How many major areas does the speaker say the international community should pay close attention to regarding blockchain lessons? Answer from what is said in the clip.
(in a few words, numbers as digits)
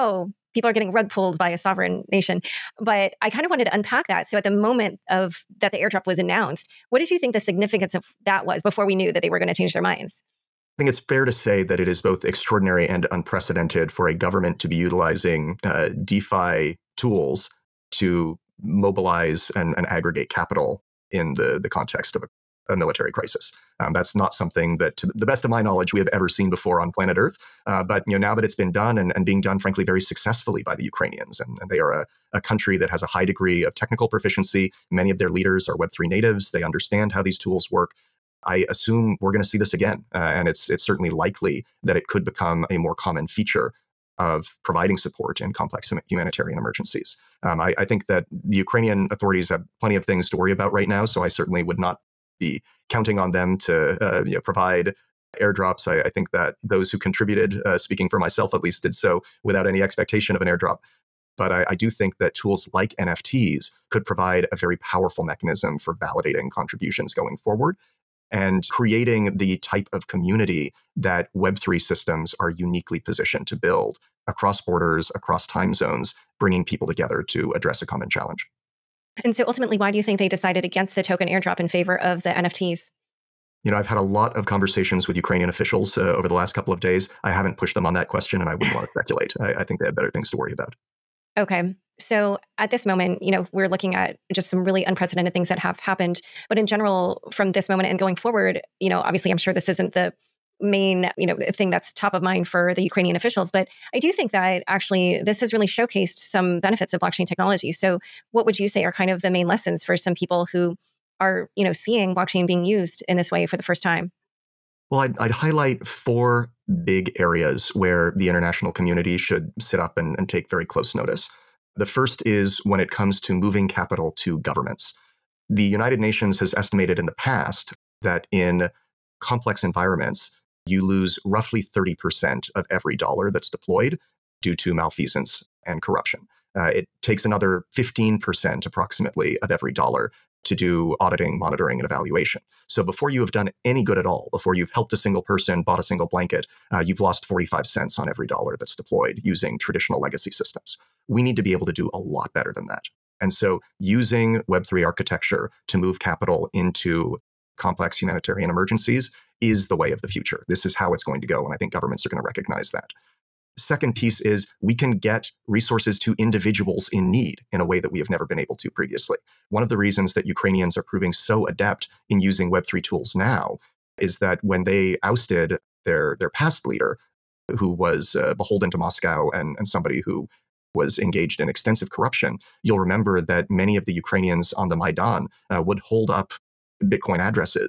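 4.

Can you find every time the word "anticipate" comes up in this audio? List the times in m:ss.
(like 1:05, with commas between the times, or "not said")
not said.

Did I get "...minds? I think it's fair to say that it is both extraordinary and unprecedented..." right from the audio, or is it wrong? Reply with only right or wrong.
right.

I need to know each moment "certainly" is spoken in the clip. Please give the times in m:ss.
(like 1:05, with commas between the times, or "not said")
0:40, 0:51.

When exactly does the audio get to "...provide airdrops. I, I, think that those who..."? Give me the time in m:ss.
0:54.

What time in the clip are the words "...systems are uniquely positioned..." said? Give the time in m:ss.
1:11.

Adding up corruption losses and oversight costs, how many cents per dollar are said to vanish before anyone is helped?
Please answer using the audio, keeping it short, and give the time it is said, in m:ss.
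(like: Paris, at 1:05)
45 cents, at 2:27.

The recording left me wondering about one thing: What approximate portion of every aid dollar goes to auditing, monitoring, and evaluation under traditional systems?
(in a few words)
15%.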